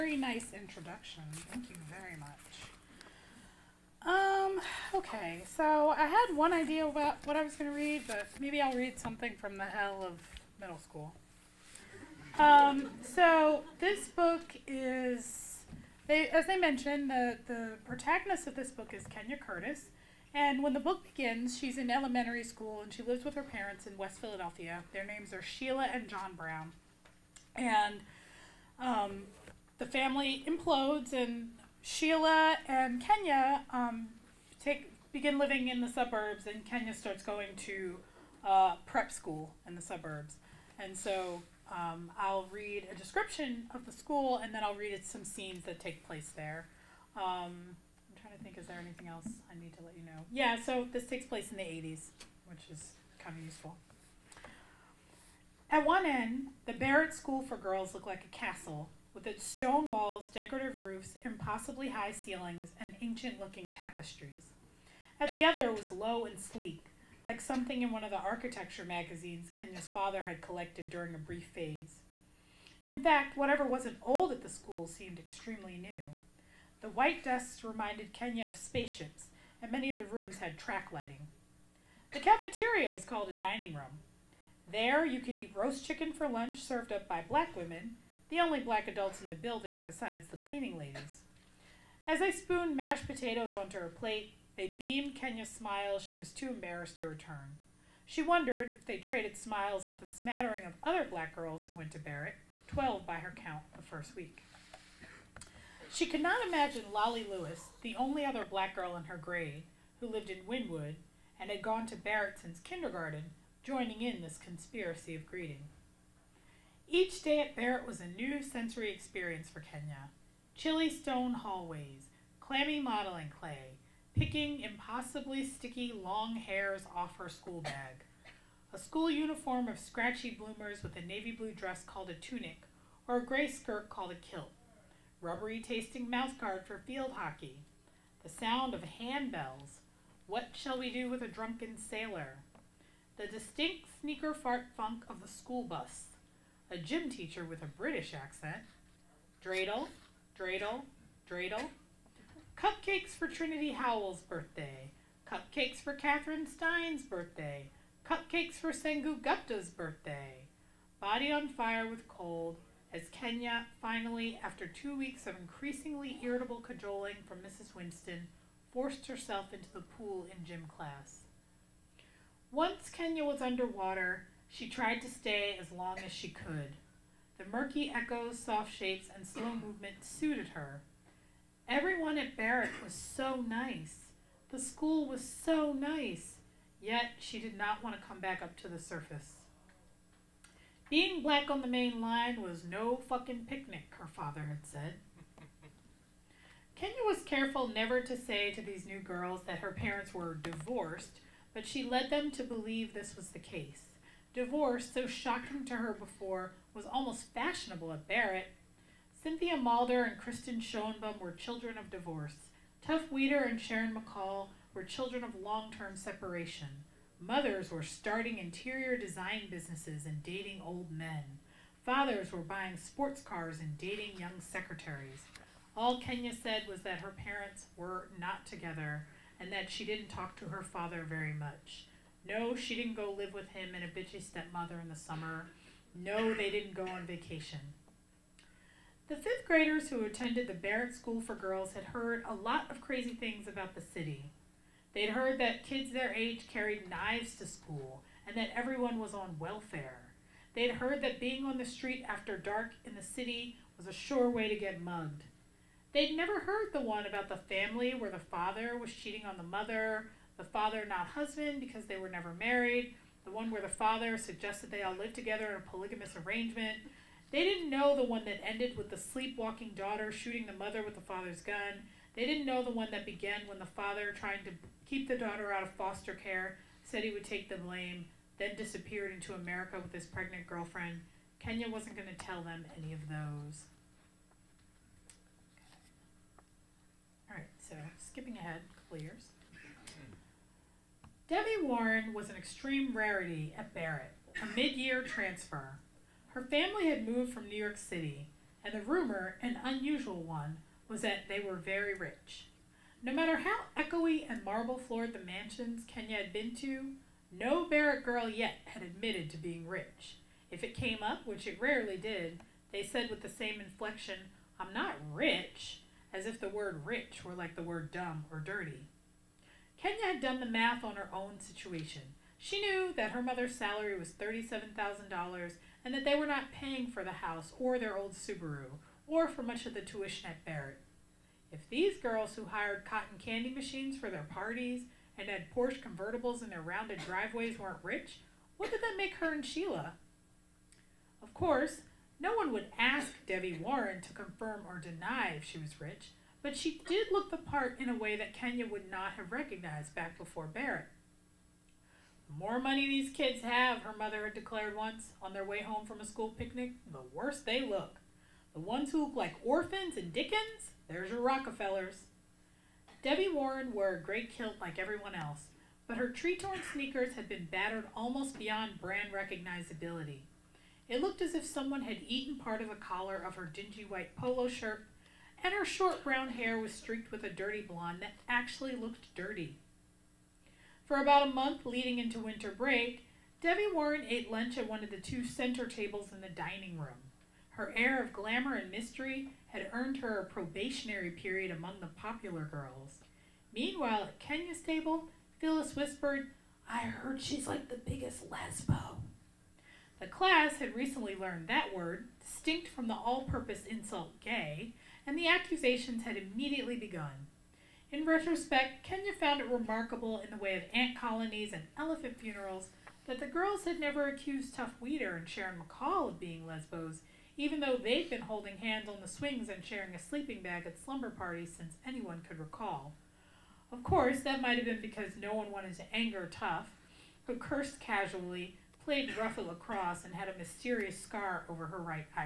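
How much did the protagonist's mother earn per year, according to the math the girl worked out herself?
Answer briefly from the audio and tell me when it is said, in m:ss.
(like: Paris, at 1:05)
$37,000, at 5:24.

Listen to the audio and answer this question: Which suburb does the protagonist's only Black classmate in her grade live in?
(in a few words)
Wynnewood.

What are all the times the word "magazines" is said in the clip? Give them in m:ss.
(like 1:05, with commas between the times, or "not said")
1:08.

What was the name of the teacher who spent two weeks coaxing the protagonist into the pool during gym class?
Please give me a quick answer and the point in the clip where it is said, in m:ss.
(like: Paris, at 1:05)
Mrs. Winston, at 2:47.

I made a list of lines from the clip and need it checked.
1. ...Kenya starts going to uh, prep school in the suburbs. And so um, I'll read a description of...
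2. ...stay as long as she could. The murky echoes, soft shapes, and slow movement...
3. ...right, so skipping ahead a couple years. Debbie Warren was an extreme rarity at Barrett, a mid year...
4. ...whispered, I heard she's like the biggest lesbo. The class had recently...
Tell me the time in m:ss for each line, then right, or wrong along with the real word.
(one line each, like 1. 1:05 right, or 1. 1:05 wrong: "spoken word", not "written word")
1. 0:36 right
2. 2:55 right
3. 4:47 right
4. 6:35 right.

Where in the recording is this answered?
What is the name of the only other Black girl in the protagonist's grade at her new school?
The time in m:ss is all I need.
1:46.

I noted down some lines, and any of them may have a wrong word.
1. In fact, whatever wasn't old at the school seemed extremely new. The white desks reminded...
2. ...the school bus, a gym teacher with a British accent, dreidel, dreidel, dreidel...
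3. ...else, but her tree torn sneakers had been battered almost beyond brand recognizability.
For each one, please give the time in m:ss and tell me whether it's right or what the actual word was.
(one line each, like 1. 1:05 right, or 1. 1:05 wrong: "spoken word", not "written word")
1. 1:12 right
2. 2:25 right
3. 6:05 right.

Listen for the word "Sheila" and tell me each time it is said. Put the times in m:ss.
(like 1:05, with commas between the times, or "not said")
0:25, 0:31, 5:39.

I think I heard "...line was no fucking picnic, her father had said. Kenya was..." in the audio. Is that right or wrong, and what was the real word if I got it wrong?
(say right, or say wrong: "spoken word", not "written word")
right.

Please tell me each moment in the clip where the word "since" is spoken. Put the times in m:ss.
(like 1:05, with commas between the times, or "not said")
1:52, 7:01.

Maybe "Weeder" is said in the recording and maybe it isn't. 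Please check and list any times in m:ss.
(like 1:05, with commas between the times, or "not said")
3:33, 6:54.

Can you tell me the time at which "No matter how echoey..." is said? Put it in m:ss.
5:03.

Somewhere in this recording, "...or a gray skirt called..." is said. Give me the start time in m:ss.
2:13.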